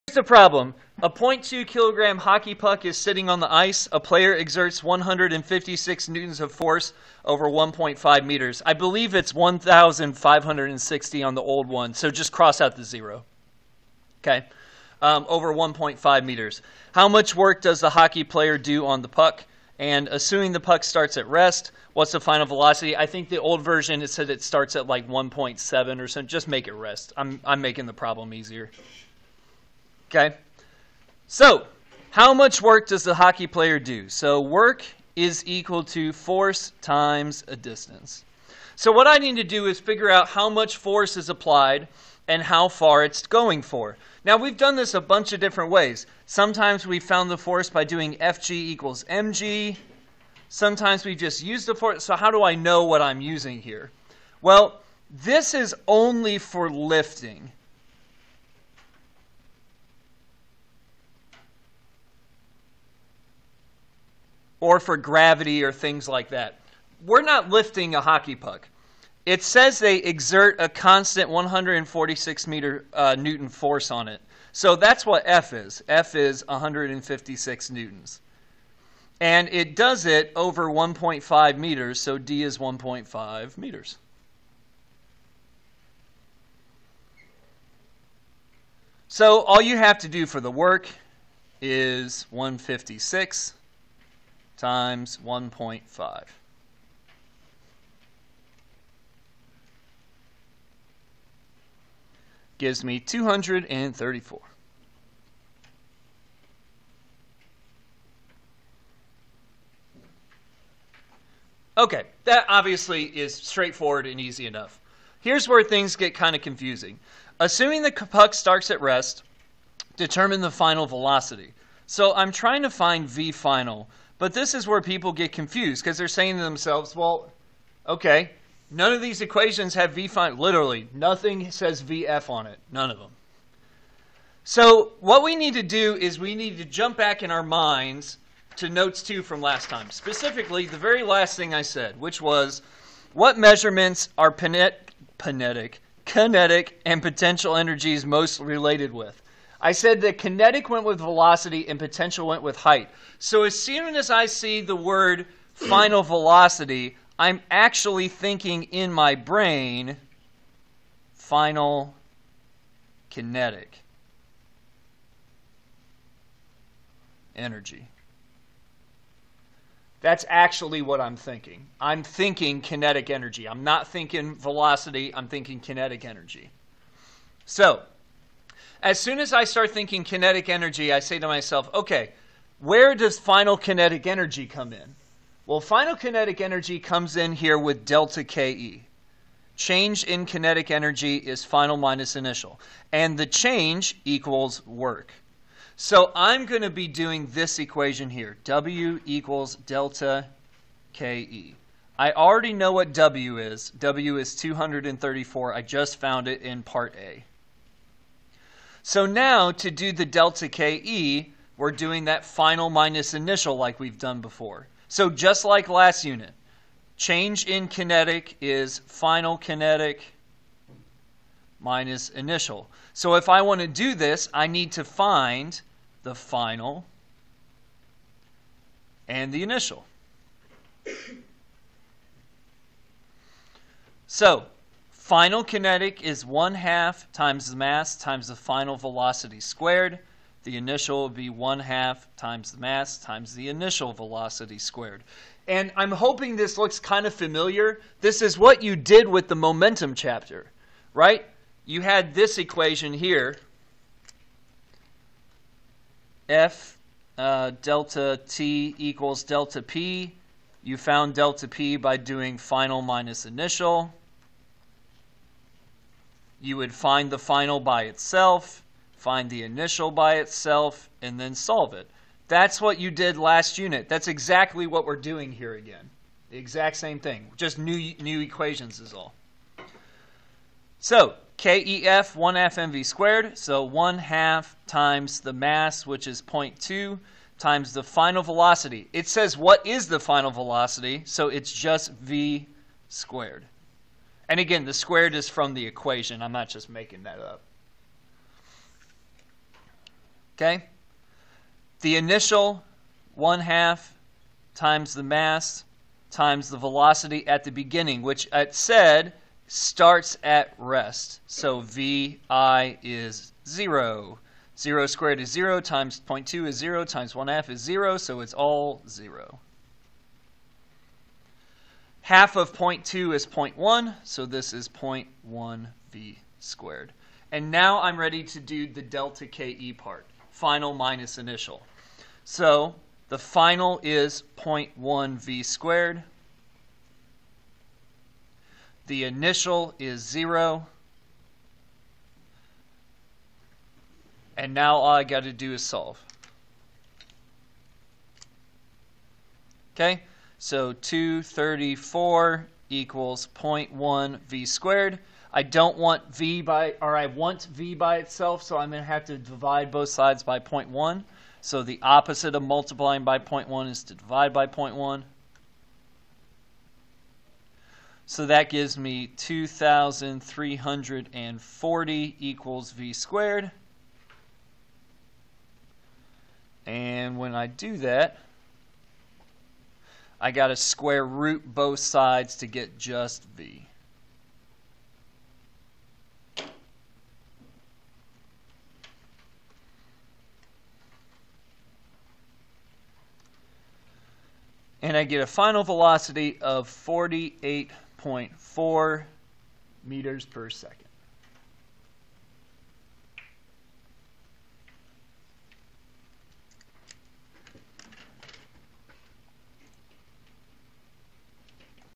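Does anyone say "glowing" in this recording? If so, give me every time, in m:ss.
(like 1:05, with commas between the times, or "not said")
not said.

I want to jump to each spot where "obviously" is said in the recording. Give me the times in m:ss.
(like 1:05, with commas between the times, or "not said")
1:52.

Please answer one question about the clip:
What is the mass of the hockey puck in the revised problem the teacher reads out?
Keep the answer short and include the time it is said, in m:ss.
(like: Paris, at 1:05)
0.2 kilograms, at 0:01.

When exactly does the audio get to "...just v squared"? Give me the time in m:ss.
4:51.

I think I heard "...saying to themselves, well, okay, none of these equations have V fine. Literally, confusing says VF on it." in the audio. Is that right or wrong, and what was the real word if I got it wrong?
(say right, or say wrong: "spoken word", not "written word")
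wrong: "nothing", not "confusing".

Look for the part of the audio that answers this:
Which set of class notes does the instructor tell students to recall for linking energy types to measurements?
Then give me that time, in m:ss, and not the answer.
2:18.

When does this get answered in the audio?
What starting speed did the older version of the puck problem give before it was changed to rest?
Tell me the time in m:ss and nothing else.
0:25.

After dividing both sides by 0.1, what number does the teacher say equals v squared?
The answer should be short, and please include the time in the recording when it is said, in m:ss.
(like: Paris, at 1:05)
2,340, at 6:09.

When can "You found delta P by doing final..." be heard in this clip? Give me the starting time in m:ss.
4:20.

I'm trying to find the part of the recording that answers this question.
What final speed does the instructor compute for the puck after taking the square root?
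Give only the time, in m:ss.
6:36.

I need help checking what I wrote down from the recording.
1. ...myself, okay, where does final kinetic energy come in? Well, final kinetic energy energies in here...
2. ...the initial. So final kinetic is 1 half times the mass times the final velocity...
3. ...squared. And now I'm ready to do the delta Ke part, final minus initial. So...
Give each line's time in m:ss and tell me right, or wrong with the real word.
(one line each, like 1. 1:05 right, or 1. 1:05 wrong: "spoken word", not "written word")
1. 3:01 wrong: "comes", not "energies"
2. 3:49 right
3. 5:26 right.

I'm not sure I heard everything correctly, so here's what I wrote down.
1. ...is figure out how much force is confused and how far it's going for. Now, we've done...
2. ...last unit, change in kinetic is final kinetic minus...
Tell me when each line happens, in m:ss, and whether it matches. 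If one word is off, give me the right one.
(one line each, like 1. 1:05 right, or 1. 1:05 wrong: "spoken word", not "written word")
1. 0:39 wrong: "applied", not "confused"
2. 3:35 right.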